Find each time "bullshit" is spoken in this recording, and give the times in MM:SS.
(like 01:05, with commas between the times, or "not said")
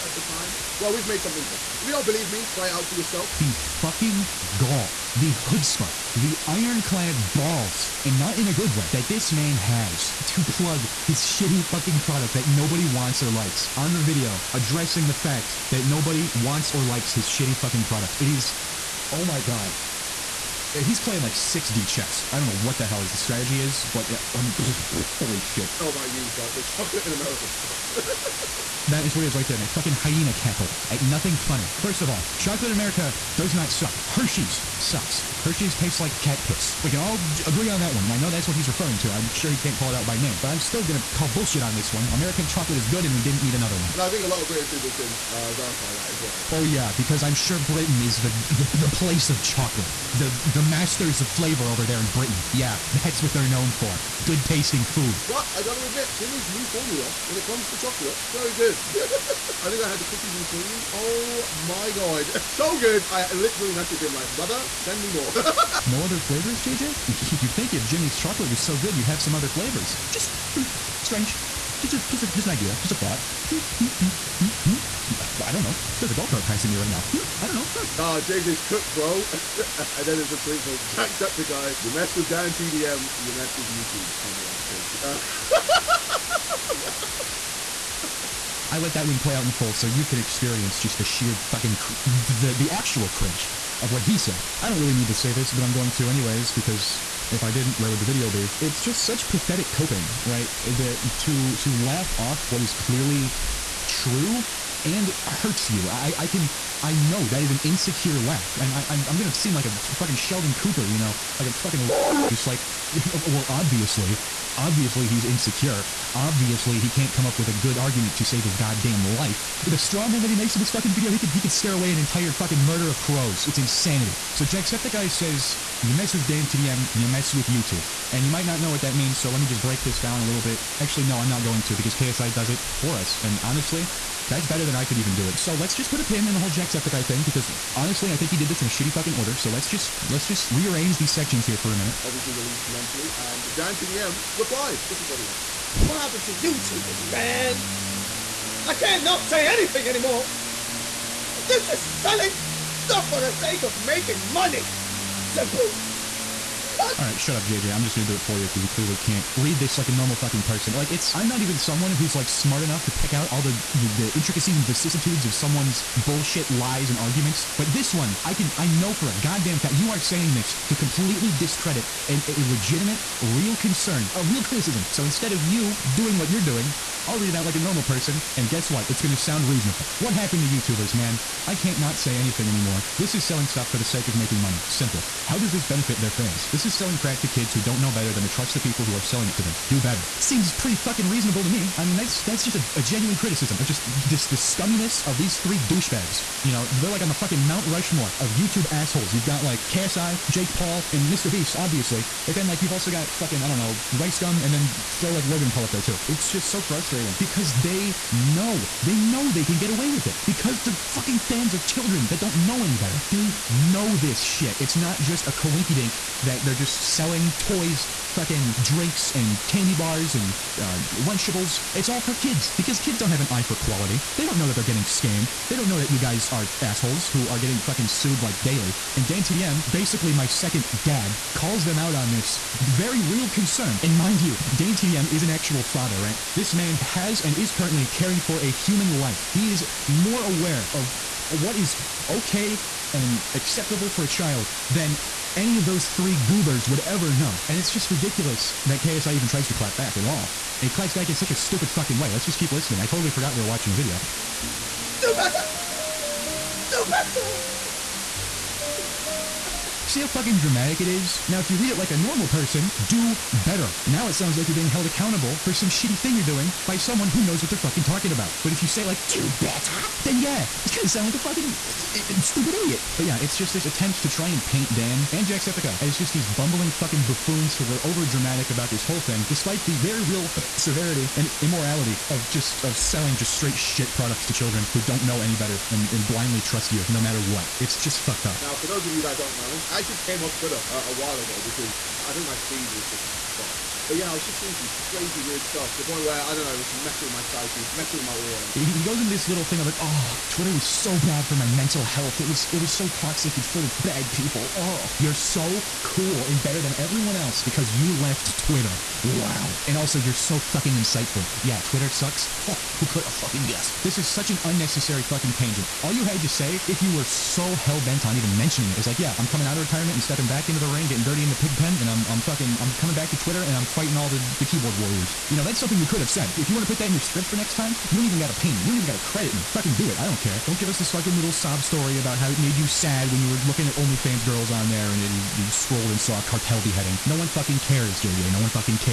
00:41, 02:45.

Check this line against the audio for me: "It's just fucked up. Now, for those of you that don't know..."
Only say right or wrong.
right.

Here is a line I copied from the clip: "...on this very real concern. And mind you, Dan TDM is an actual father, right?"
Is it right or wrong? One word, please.
right.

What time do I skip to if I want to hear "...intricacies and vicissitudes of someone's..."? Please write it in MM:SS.
02:44.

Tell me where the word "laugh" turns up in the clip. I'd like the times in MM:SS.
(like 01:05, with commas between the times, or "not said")
01:41, 01:48.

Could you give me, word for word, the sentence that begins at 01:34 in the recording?
I don't really need to say this, but I'm going to anyways because if I didn't, where would the video be?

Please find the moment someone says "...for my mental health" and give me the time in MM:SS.
05:01.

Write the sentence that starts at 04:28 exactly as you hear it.
But if you say like, do better, then yeah, he's gonna sound like a fucking uh, uh, uh, stupid idiot.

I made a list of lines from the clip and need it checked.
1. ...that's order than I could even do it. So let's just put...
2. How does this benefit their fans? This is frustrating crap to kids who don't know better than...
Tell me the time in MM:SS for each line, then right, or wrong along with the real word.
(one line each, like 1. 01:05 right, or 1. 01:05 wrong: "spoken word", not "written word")
1. 02:14 wrong: "better", not "order"
2. 03:05 wrong: "selling", not "frustrating".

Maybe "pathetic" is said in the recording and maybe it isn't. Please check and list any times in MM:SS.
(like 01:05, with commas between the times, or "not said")
01:39.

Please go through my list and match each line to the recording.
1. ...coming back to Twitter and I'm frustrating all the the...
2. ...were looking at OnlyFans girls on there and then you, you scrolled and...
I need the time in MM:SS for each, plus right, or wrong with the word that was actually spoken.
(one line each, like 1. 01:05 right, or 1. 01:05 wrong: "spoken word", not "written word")
1. 05:22 wrong: "fighting", not "frustrating"
2. 05:33 right.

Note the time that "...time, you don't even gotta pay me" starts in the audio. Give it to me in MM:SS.
05:27.